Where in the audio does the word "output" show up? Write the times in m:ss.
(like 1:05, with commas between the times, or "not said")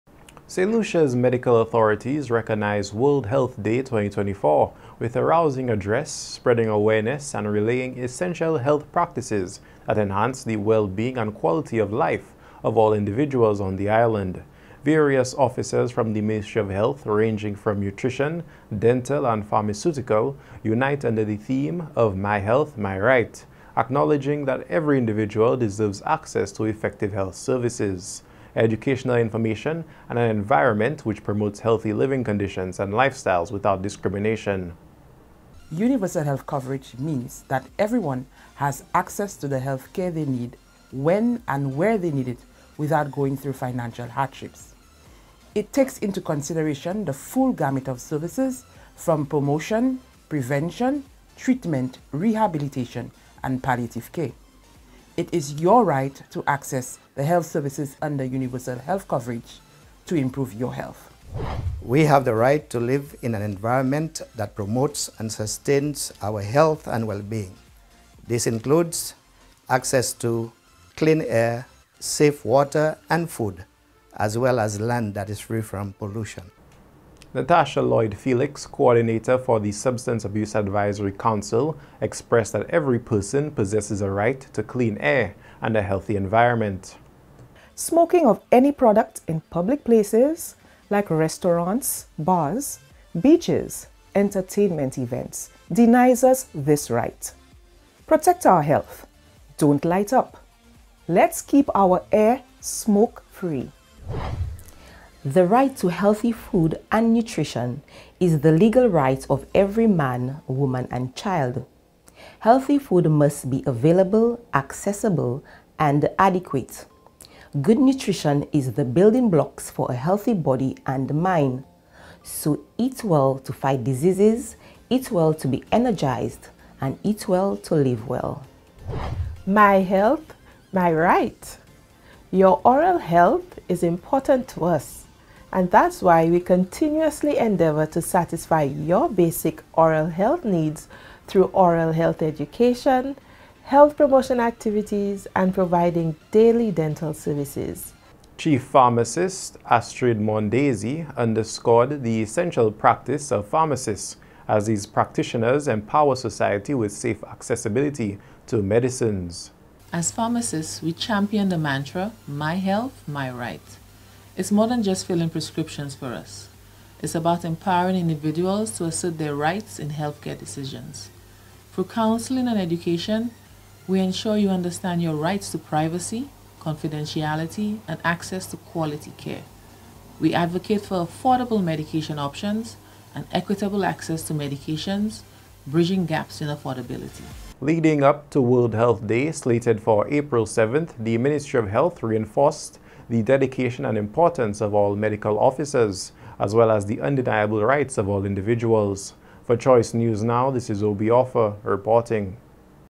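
not said.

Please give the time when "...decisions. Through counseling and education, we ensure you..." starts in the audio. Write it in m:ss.
2:50.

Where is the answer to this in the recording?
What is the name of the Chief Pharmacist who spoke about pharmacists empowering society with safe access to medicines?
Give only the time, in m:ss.
2:29.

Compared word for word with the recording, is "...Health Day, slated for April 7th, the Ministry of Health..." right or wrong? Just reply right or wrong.
right.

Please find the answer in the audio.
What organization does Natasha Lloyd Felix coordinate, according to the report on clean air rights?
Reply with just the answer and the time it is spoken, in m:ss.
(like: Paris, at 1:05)
Substance Abuse Advisory Council, at 1:19.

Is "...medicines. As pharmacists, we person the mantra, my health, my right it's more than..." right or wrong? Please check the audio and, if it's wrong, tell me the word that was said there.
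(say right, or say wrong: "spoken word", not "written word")
wrong: "champion", not "person".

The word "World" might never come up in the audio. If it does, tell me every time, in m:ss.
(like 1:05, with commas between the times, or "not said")
0:02, 3:08.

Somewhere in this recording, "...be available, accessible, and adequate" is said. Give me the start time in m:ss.
1:53.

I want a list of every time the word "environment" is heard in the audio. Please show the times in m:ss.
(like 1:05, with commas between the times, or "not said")
0:30, 1:03, 1:26.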